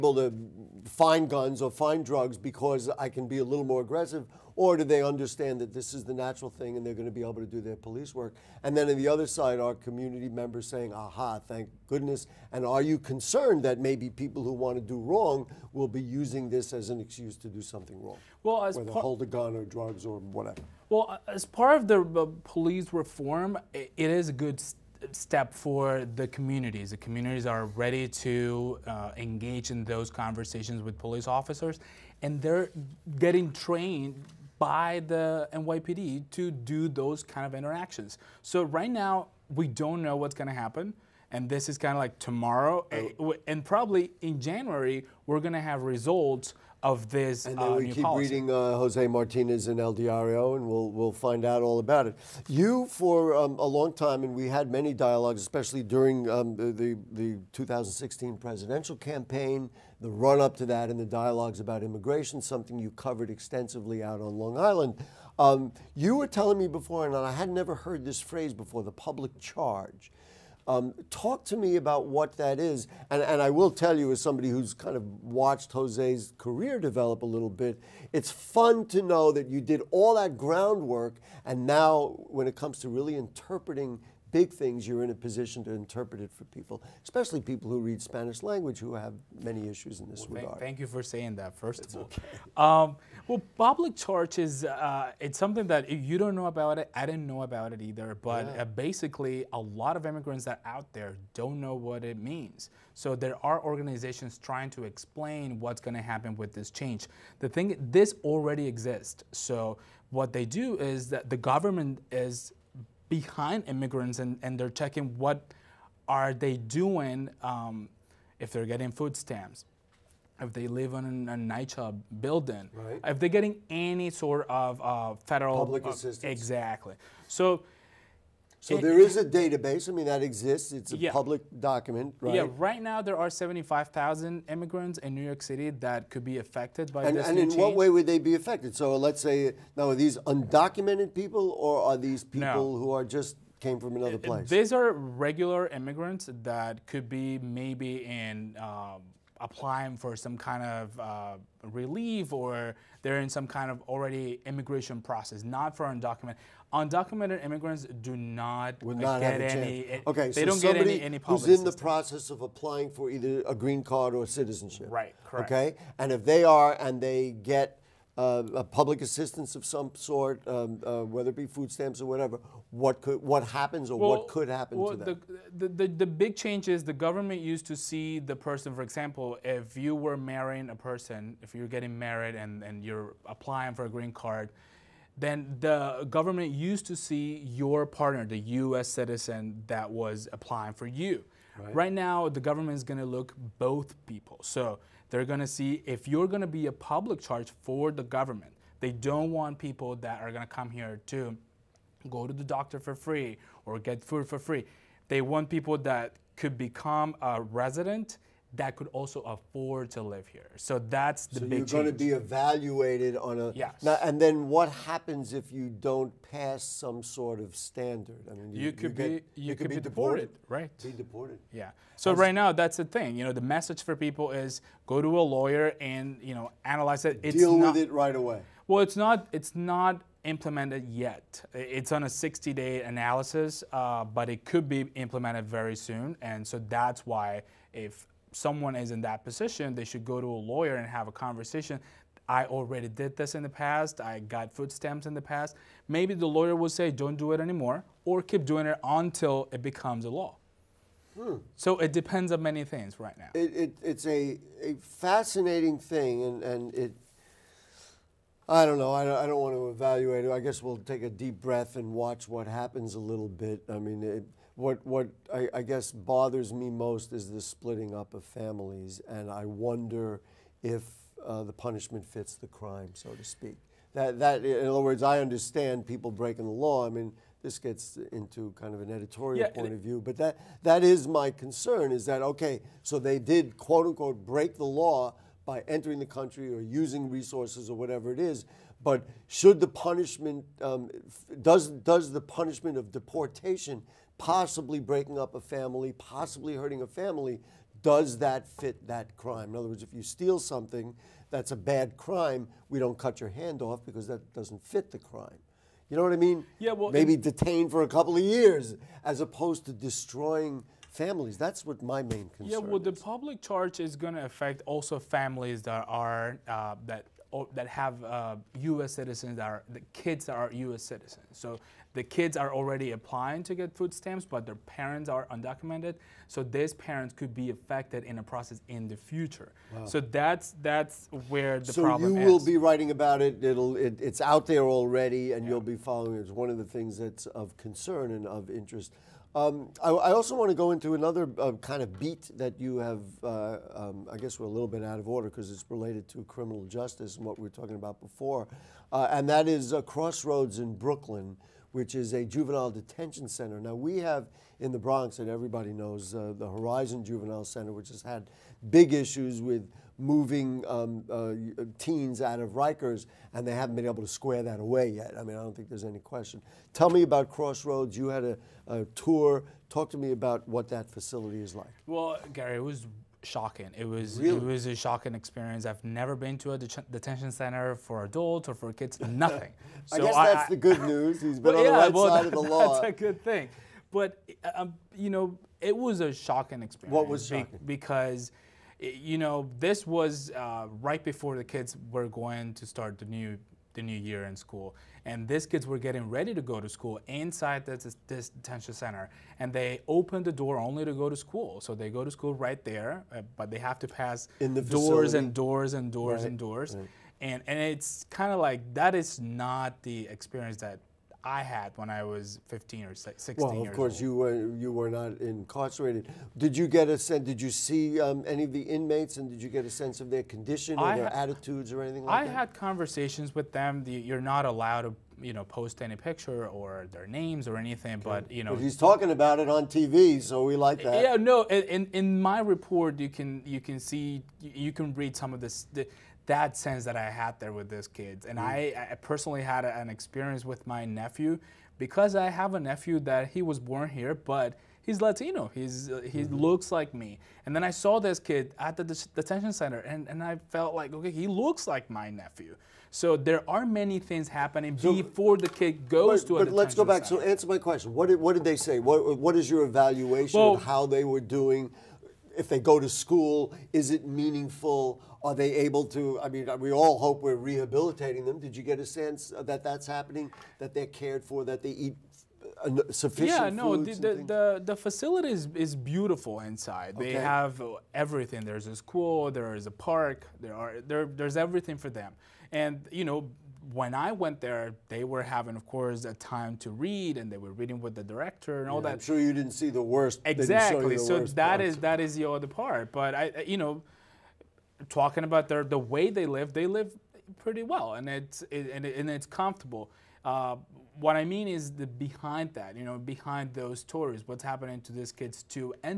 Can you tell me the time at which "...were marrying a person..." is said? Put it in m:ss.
2:59.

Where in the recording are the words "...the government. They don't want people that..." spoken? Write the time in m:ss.
3:17.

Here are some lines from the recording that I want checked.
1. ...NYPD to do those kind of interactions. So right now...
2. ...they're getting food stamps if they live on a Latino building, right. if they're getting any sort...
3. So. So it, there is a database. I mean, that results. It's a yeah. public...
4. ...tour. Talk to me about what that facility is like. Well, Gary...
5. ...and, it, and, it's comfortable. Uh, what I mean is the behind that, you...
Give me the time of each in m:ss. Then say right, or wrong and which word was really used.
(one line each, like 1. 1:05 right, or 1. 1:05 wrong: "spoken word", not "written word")
1. 0:35 right
2. 1:58 wrong: "NYCHA", not "Latino"
3. 2:07 wrong: "exists", not "results"
4. 6:08 right
5. 8:18 right.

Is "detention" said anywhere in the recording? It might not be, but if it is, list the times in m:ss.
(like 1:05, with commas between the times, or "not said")
5:52, 6:16, 6:38, 7:29.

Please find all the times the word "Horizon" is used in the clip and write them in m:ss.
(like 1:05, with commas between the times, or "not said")
5:56.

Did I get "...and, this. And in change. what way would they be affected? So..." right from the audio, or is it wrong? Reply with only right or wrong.
right.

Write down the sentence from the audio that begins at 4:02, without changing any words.
I already did this in the past.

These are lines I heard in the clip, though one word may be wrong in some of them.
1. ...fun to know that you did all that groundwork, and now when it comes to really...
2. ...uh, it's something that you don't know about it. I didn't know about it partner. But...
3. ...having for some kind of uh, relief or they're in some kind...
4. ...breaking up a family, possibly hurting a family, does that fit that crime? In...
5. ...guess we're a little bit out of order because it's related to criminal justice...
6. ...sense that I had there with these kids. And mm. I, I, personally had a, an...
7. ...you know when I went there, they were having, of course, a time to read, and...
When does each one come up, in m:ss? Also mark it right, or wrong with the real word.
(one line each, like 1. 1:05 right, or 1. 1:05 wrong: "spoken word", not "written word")
1. 1:18 right
2. 1:34 wrong: "either", not "partner"
3. 2:29 wrong: "applying", not "having"
4. 4:54 right
5. 5:44 right
6. 7:16 right
7. 8:02 right.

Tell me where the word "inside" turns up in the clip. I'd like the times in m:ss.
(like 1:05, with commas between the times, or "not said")
6:37, 7:56.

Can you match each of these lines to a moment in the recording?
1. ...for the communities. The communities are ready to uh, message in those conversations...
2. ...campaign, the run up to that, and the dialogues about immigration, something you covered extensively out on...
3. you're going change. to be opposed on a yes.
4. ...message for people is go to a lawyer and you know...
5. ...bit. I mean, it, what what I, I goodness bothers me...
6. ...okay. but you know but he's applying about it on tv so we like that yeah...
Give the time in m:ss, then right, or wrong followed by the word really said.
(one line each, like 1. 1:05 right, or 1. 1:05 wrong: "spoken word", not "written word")
1. 0:25 wrong: "engage", not "message"
2. 0:58 right
3. 3:31 wrong: "evaluated", not "opposed"
4. 3:43 right
5. 4:23 wrong: "guess", not "goodness"
6. 7:07 wrong: "talking", not "applying".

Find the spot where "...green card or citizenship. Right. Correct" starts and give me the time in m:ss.
2:43.